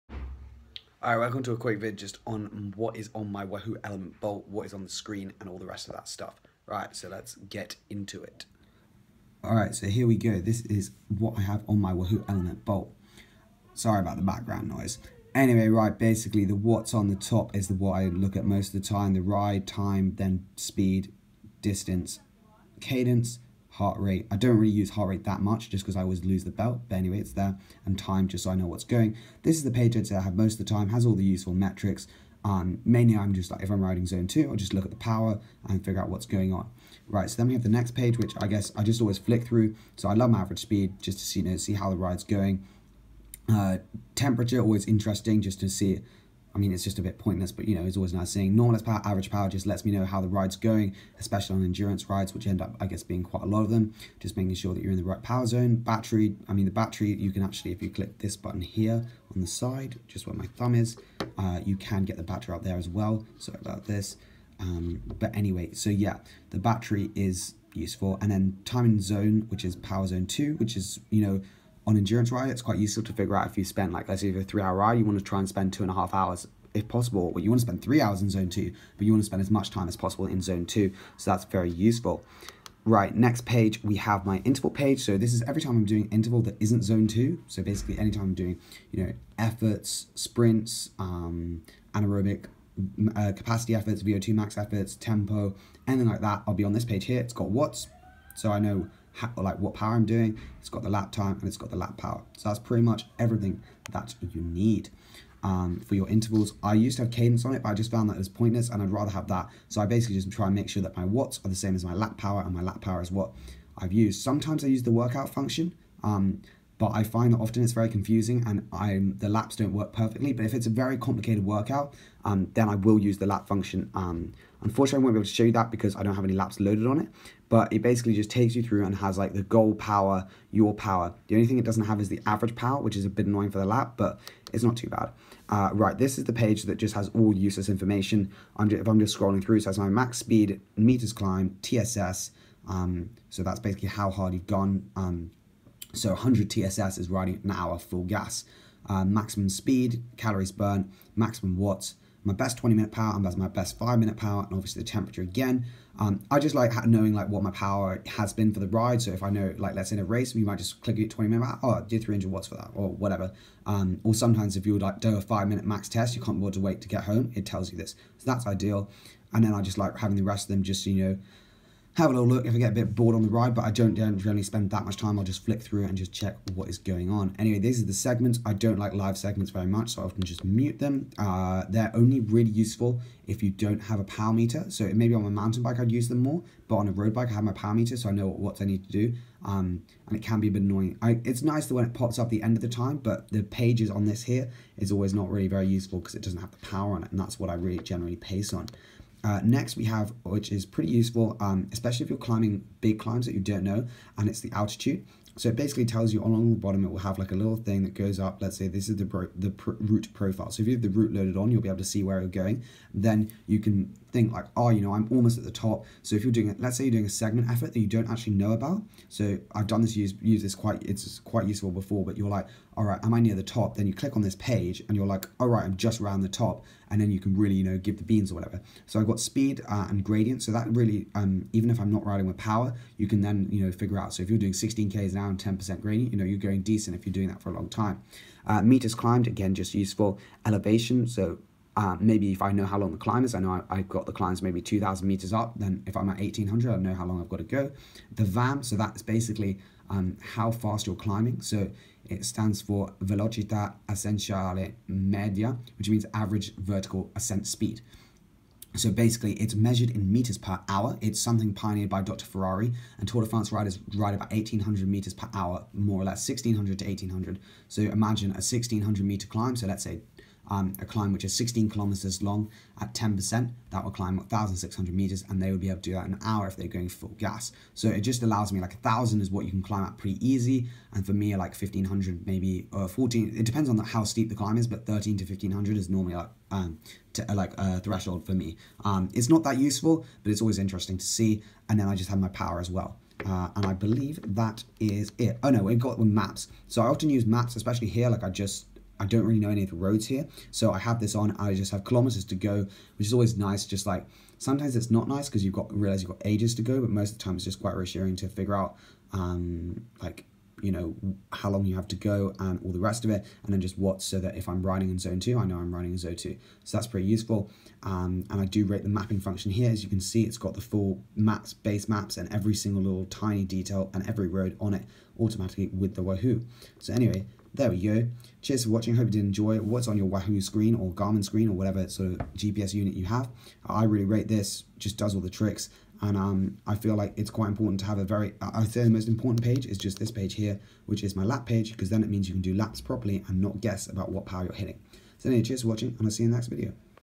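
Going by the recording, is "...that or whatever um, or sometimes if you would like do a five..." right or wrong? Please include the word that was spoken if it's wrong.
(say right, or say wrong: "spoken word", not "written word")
right.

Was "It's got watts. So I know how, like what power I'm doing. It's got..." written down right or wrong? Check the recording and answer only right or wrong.
right.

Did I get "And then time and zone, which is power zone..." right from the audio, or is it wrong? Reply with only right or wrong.
right.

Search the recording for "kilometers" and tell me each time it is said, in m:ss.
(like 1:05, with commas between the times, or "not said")
4:31, 5:01.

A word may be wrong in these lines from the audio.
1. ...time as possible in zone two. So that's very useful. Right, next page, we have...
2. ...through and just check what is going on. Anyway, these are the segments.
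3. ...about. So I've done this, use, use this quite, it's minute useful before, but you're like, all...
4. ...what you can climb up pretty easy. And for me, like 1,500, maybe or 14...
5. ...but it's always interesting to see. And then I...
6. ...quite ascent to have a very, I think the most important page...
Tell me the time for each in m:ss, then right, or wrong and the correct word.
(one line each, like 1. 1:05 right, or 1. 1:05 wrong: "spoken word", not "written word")
1. 1:19 right
2. 2:55 right
3. 3:38 wrong: "quite", not "minute"
4. 4:39 right
5. 4:50 right
6. 5:37 wrong: "important", not "ascent".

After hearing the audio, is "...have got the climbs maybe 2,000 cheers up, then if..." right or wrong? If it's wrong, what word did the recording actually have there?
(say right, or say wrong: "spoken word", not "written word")
wrong: "meters", not "cheers".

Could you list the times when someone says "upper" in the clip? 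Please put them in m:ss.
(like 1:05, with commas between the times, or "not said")
not said.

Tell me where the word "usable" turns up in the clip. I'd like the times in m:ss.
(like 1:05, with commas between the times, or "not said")
not said.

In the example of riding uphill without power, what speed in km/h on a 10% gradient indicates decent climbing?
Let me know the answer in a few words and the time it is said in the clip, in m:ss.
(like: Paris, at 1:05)
16 km/h, at 3:54.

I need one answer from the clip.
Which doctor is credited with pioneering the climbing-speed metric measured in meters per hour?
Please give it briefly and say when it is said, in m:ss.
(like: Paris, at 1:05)
Dr. Ferrari, at 4:22.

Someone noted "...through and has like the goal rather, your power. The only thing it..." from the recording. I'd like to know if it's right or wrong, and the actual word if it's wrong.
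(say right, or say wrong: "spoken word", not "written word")
wrong: "power", not "rather".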